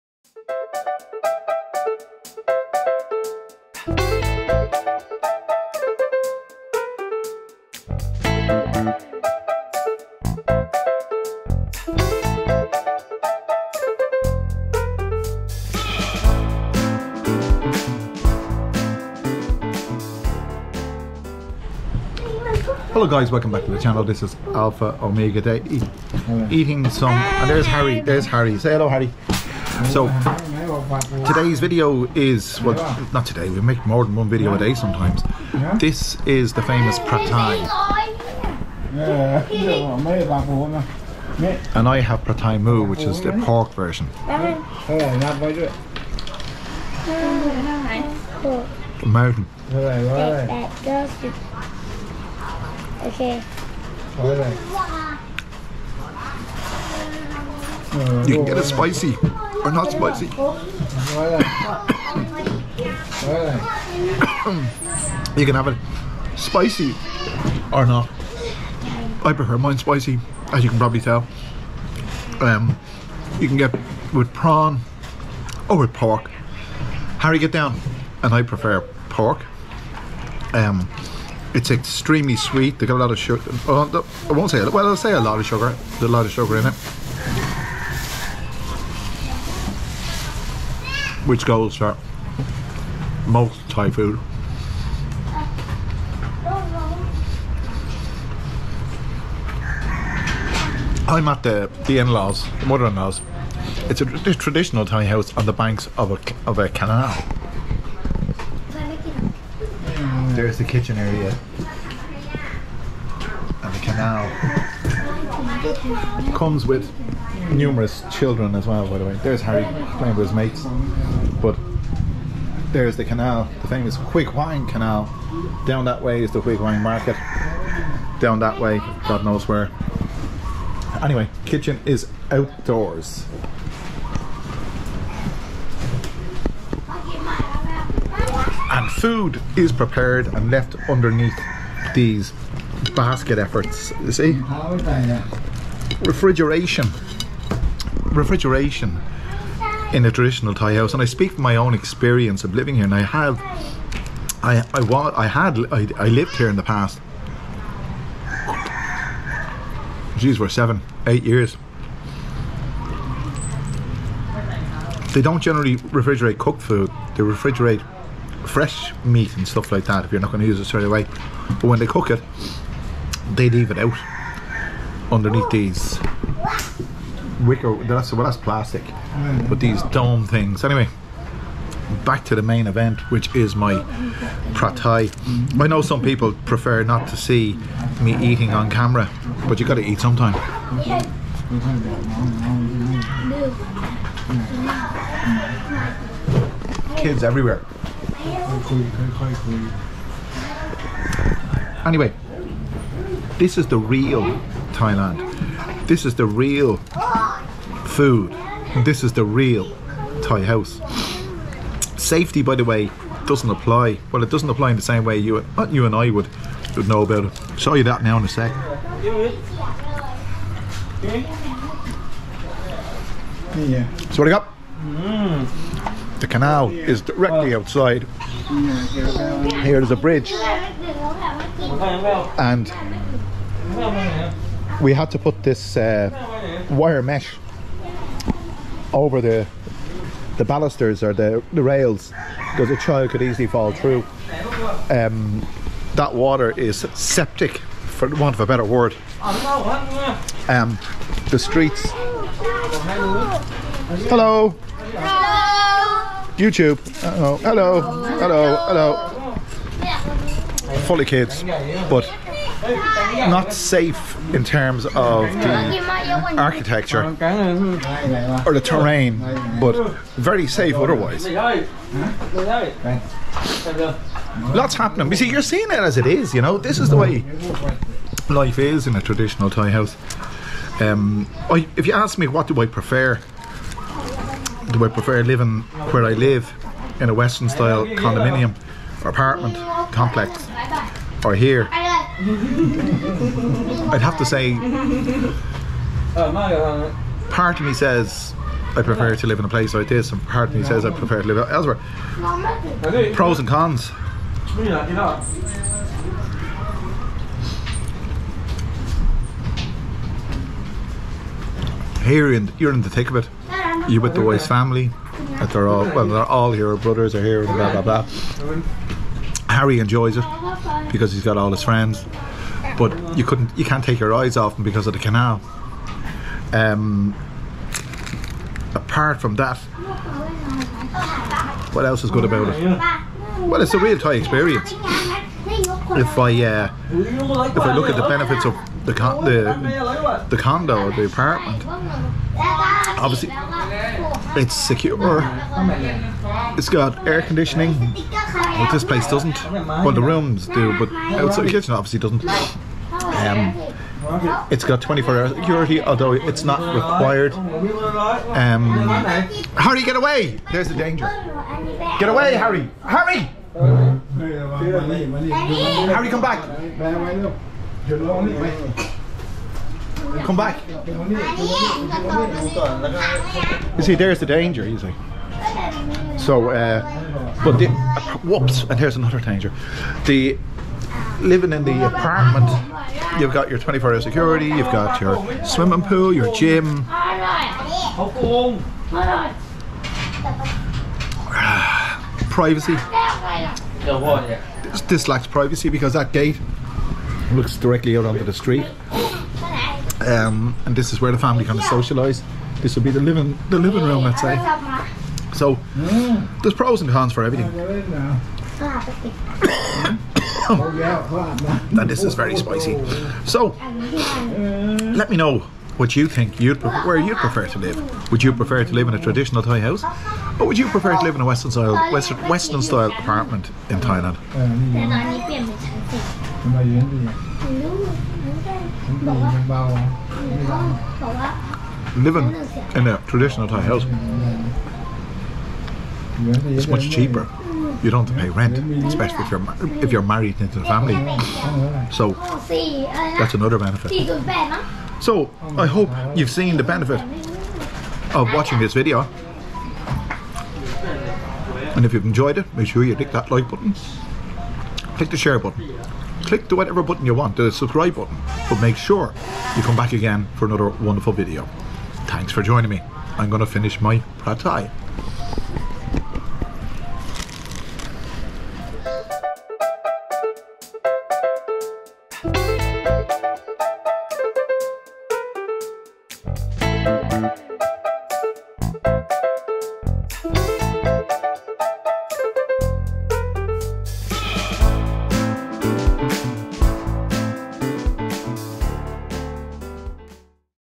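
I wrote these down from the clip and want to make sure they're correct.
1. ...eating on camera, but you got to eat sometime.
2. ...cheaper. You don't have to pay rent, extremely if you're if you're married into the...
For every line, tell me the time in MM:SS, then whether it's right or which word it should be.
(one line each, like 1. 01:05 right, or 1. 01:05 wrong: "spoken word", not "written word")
1. 03:08 right
2. 07:16 wrong: "especially", not "extremely".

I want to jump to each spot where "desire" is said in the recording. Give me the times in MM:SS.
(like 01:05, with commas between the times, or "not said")
not said.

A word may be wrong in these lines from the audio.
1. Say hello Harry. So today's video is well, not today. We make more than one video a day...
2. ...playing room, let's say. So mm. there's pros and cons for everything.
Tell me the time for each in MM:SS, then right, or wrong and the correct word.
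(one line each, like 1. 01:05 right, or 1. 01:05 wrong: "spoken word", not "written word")
1. 00:28 right
2. 06:43 wrong: "living", not "playing".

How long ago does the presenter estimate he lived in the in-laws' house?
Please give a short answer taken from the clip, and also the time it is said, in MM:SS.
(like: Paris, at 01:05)
7 or 8 years, at 02:40.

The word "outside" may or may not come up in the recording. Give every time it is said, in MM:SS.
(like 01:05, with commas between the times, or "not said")
03:47, 05:51.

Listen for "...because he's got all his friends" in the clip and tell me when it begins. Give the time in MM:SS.
05:20.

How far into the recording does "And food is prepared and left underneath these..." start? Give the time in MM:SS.
02:18.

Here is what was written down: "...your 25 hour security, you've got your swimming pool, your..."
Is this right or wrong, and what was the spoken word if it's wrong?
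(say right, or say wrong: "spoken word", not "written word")
wrong: "24", not "25".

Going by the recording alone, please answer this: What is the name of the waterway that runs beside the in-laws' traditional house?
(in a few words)
Huai Khwang Canal.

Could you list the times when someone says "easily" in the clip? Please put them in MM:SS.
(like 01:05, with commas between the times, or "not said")
04:03.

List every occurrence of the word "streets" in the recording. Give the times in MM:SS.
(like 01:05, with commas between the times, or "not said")
04:11, 06:38.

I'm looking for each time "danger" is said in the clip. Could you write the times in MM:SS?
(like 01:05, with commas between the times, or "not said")
06:00, 06:14, 06:19.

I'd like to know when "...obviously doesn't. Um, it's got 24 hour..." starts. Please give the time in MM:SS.
05:51.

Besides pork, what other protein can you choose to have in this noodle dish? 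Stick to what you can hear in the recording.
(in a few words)
Prawn.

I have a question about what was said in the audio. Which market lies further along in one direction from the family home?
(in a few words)
Huai Khwang Market.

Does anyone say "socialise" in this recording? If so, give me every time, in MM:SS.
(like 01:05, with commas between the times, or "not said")
06:41.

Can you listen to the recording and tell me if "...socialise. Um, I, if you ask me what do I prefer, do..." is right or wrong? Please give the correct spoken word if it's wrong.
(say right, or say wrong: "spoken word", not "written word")
wrong: "house", not "socialise".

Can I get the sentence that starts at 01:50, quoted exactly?
there's the kitchen area and the canal.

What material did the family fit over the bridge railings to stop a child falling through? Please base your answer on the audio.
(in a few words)
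Wire mesh.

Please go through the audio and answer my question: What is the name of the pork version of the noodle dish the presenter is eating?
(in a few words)
Pad thai moo.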